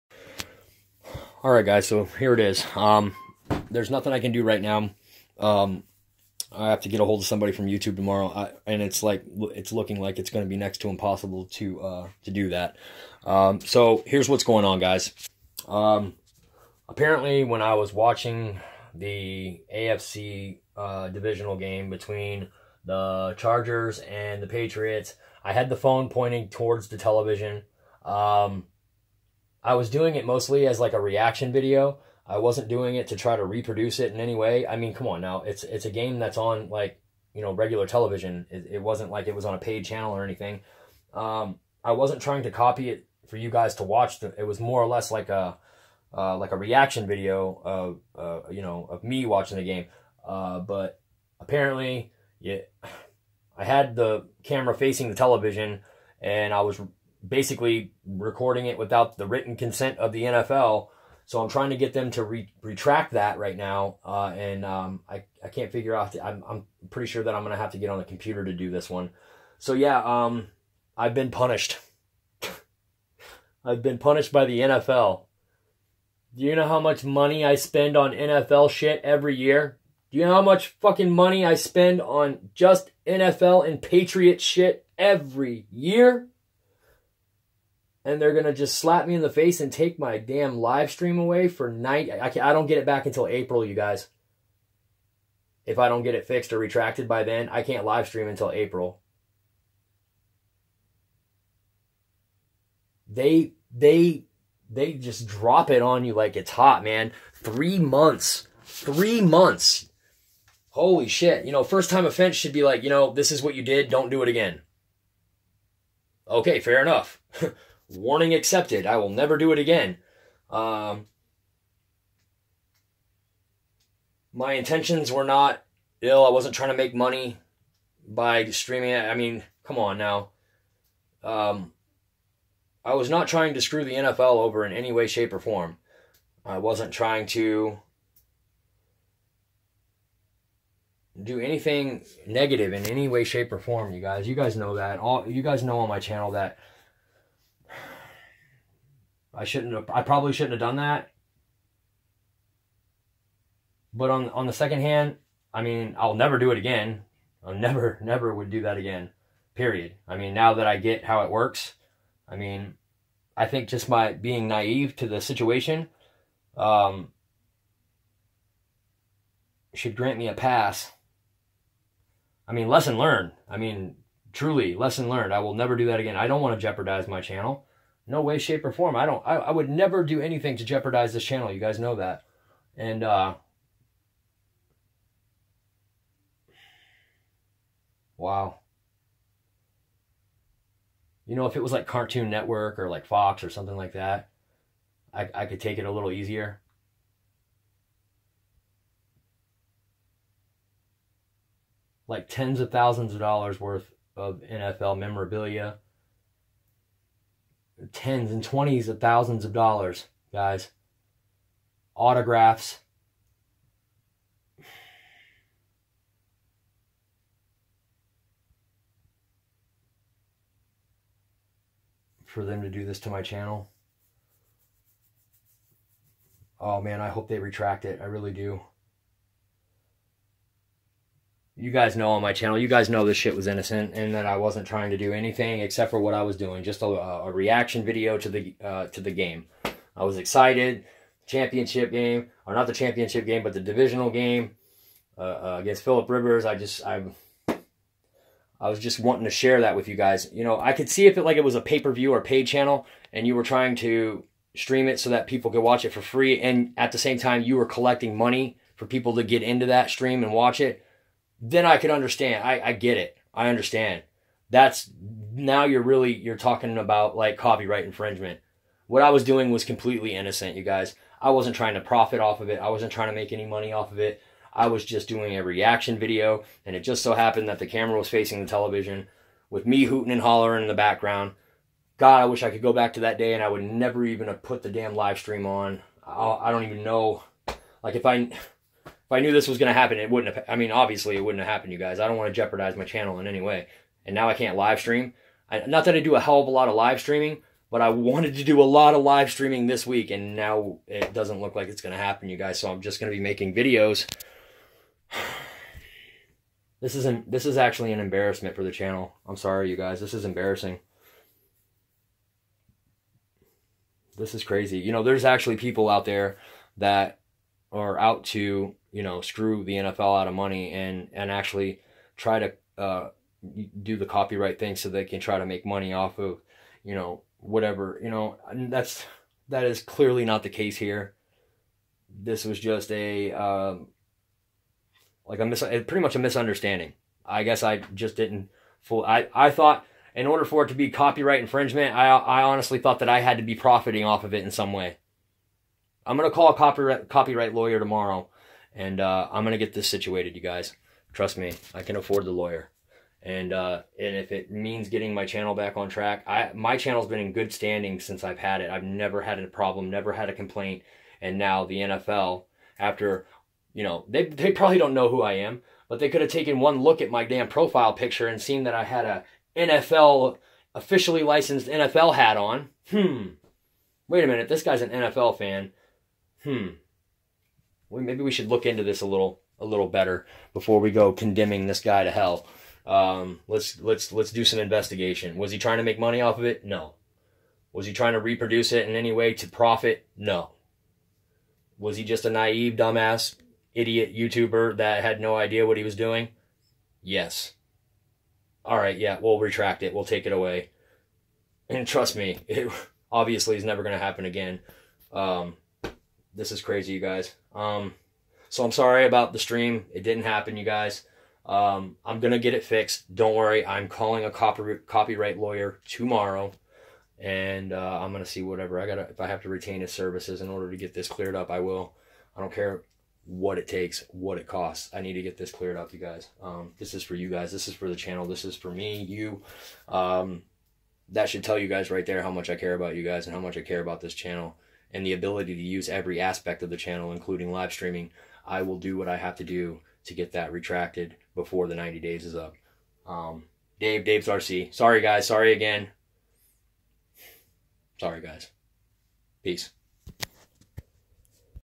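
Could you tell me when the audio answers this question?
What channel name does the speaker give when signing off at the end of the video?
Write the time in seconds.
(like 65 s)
444 s.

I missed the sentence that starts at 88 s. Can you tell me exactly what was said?
and they're gonna just slap me in the face and take my damn live stream away for night.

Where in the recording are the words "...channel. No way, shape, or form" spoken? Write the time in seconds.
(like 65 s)
177 s.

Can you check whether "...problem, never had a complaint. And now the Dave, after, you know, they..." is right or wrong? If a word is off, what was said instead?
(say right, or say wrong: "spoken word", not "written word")
wrong: "NFL", not "Dave".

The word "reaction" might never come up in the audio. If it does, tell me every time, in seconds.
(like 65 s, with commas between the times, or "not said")
30 s, 46 s, 237 s, 275 s.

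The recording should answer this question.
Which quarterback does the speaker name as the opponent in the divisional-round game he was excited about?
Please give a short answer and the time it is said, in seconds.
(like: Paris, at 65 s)
Philip Rivers, at 245 s.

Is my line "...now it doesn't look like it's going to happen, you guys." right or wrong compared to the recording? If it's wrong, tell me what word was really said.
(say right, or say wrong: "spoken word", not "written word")
right.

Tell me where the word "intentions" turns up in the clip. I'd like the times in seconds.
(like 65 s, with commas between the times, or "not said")
124 s.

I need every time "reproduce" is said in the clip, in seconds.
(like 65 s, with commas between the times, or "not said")
33 s, 388 s.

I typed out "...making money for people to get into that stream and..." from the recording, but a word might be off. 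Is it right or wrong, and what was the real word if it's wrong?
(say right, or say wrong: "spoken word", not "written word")
wrong: "collecting", not "making".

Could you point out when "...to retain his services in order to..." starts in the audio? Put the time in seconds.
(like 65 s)
419 s.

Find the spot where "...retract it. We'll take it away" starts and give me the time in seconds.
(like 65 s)
399 s.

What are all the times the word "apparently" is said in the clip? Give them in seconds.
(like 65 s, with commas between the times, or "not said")
16 s, 51 s.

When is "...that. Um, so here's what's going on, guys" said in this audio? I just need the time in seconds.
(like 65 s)
12 s.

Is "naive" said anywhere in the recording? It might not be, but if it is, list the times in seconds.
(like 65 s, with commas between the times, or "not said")
164 s, 392 s.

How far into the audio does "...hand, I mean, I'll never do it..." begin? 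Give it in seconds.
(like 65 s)
154 s.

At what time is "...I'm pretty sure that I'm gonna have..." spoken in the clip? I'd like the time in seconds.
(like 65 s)
66 s.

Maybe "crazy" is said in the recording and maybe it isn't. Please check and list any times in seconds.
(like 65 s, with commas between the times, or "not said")
314 s, 406 s.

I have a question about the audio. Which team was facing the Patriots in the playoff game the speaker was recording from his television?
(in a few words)
Chargers.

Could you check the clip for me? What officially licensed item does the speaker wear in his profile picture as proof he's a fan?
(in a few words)
NFL hat.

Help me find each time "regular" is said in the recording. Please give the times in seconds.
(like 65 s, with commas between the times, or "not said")
37 s.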